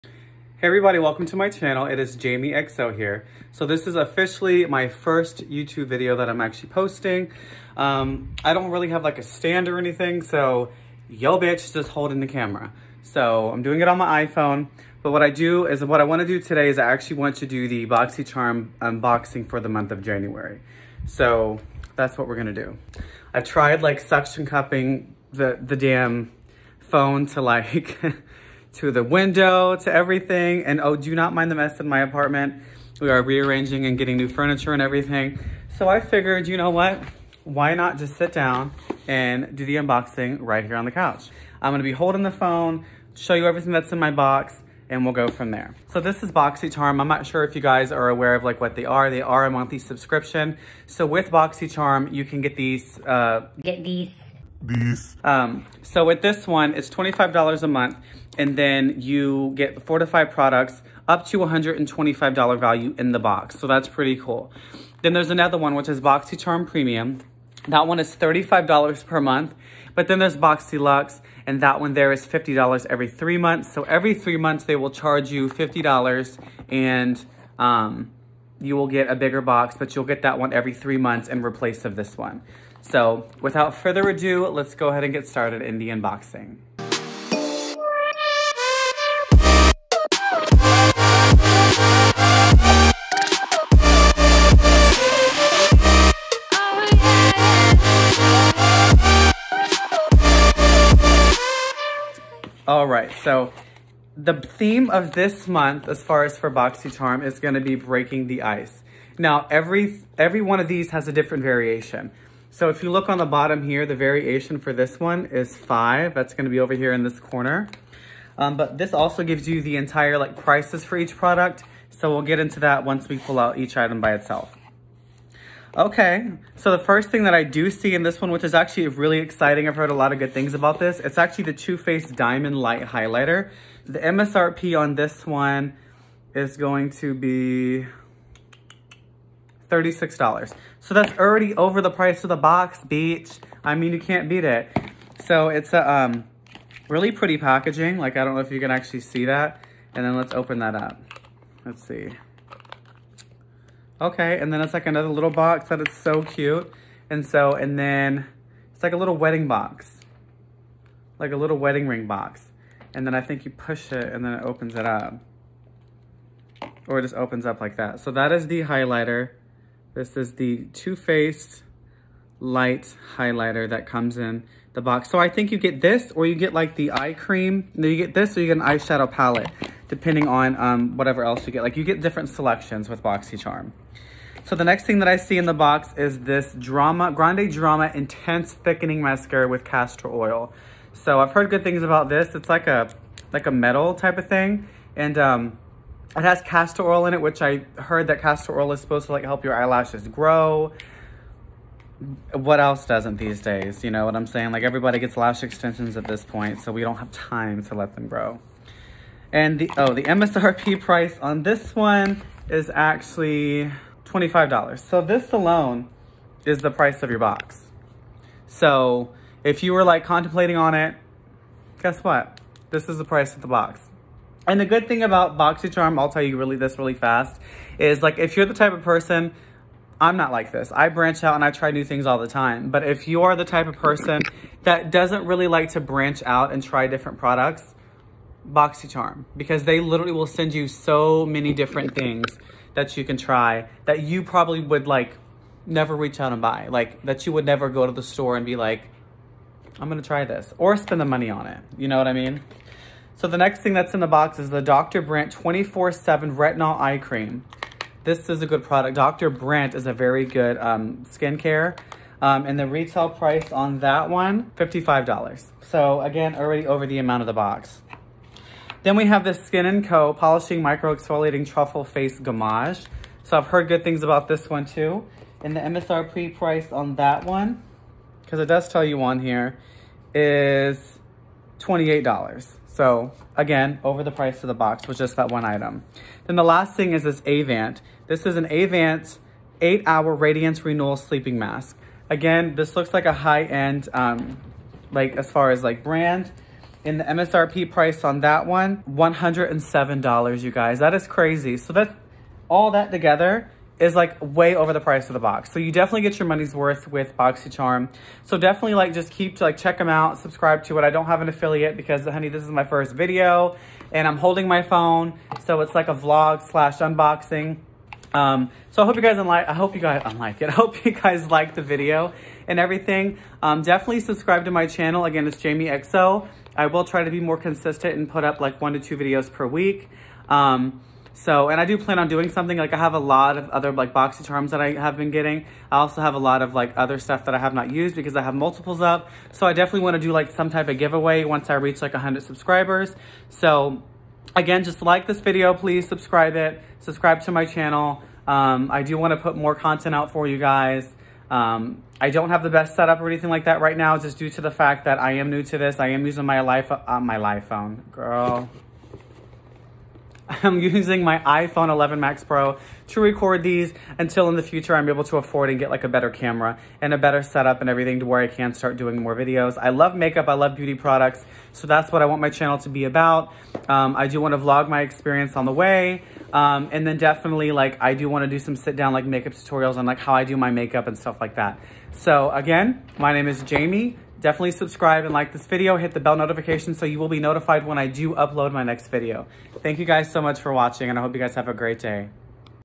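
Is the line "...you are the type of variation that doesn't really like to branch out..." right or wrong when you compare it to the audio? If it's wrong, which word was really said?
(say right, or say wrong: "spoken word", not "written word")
wrong: "person", not "variation".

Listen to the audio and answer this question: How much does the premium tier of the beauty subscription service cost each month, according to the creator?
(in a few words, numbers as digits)
$35.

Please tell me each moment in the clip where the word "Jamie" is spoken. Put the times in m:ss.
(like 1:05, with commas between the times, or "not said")
0:02, 5:25, 6:23.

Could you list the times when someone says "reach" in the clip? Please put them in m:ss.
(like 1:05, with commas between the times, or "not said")
4:05, 5:41.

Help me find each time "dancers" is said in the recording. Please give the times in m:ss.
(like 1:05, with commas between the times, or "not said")
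not said.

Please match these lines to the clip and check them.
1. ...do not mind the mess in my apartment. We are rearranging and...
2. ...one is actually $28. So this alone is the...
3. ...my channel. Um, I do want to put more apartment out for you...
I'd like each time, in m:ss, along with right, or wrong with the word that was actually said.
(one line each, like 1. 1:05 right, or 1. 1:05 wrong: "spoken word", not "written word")
1. 0:30 right
2. 3:31 wrong: "25", not "28"
3. 5:47 wrong: "content", not "apartment".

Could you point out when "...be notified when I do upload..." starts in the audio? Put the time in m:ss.
6:27.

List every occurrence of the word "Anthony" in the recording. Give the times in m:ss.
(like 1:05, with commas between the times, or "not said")
not said.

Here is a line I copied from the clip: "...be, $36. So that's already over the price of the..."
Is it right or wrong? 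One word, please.
right.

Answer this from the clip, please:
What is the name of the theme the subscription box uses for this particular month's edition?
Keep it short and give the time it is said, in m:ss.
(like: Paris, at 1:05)
Breaking the ice, at 1:47.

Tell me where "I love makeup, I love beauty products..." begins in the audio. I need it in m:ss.
6:09.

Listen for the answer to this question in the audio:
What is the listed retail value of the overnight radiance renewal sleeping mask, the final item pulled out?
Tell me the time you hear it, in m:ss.
4:58.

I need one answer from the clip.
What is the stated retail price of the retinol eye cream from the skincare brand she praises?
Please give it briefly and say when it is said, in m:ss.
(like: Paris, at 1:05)
$55, at 4:24.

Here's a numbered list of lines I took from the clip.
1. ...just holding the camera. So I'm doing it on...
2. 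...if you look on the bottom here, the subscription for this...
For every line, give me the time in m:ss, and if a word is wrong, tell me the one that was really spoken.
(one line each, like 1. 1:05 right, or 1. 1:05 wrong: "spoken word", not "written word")
1. 0:11 right
2. 1:52 wrong: "variation", not "subscription".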